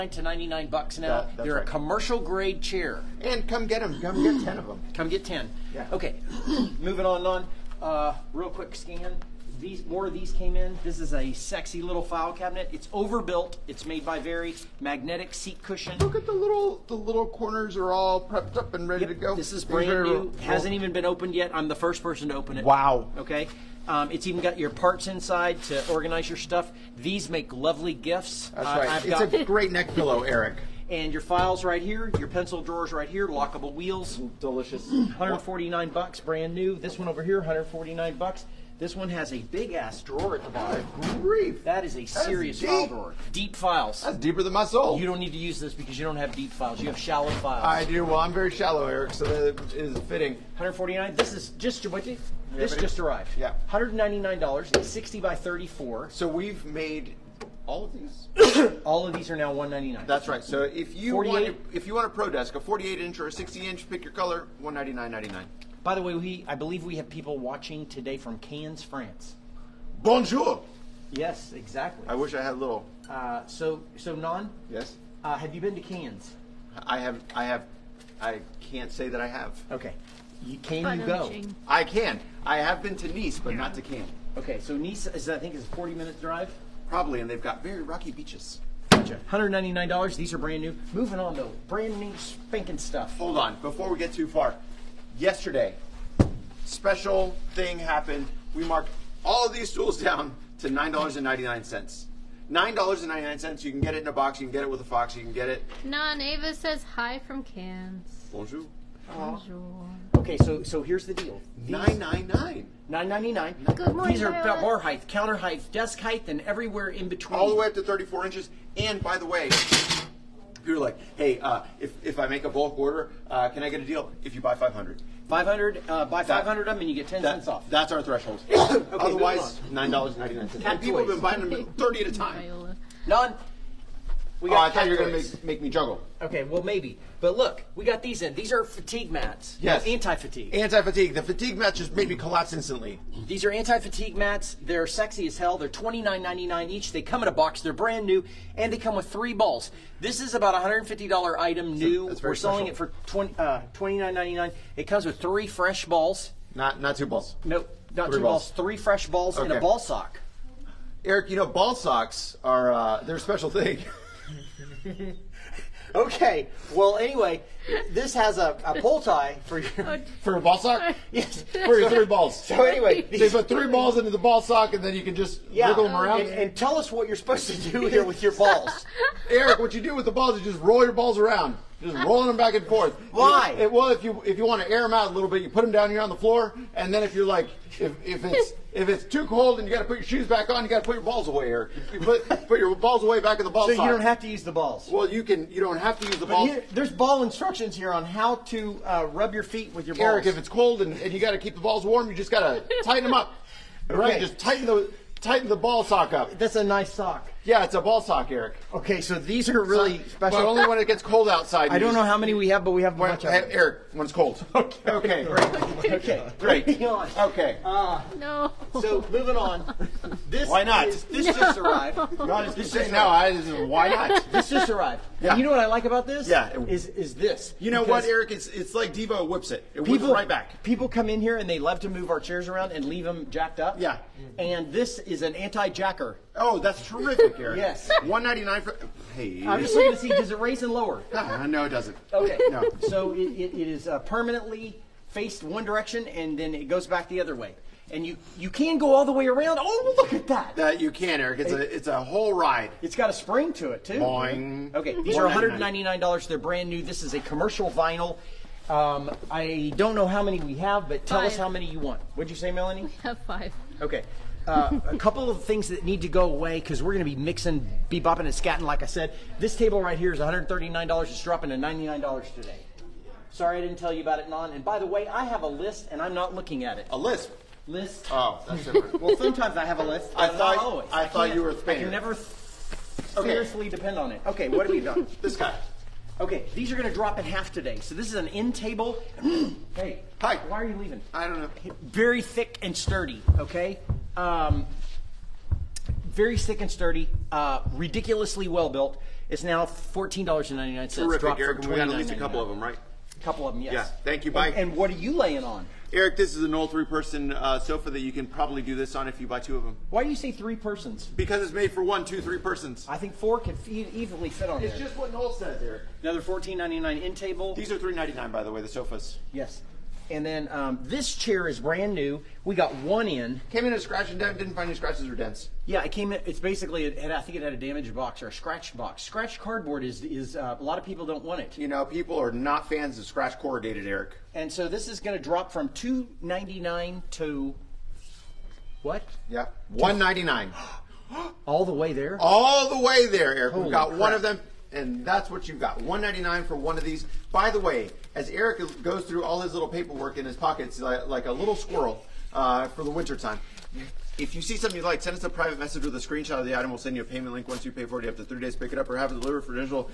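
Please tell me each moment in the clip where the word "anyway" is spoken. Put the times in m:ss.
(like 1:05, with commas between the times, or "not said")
2:46, 2:52.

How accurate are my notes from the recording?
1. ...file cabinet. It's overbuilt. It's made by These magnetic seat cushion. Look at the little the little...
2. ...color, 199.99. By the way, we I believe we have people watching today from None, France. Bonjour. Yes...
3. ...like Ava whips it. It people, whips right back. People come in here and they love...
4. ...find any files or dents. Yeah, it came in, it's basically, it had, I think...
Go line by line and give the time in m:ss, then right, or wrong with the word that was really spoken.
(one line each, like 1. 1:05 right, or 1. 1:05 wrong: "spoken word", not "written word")
1. 0:12 wrong: "Very", not "These"
2. 1:04 wrong: "Cannes", not "None"
3. 3:48 wrong: "Devo", not "Ava"
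4. 5:24 wrong: "scratches", not "files".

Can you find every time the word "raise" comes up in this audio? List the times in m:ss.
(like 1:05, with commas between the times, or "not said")
4:00.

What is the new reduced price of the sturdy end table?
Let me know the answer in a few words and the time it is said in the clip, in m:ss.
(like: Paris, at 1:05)
$14.99, at 4:59.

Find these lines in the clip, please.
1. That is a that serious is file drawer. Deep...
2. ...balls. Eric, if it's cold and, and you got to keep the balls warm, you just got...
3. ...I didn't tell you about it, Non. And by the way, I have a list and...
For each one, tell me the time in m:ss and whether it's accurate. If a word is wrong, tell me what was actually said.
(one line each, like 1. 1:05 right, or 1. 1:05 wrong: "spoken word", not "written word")
1. 0:41 right
2. 3:19 right
3. 4:33 right.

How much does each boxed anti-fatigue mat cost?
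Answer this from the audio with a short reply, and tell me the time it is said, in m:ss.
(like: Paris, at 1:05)
$29.99, at 2:25.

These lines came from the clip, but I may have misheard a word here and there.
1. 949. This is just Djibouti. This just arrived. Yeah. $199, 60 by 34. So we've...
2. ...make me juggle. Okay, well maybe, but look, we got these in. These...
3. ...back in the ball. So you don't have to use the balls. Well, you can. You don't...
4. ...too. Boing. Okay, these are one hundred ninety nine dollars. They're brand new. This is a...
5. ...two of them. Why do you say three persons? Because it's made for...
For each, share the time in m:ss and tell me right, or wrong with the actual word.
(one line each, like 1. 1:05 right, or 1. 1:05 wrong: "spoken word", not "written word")
1. 0:50 wrong: "149", not "949"
2. 2:15 right
3. 3:13 right
4. 4:13 right
5. 5:09 right.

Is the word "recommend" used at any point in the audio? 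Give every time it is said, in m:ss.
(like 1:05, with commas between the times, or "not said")
not said.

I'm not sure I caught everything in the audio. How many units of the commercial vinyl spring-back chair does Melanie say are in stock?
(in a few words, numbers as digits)
5.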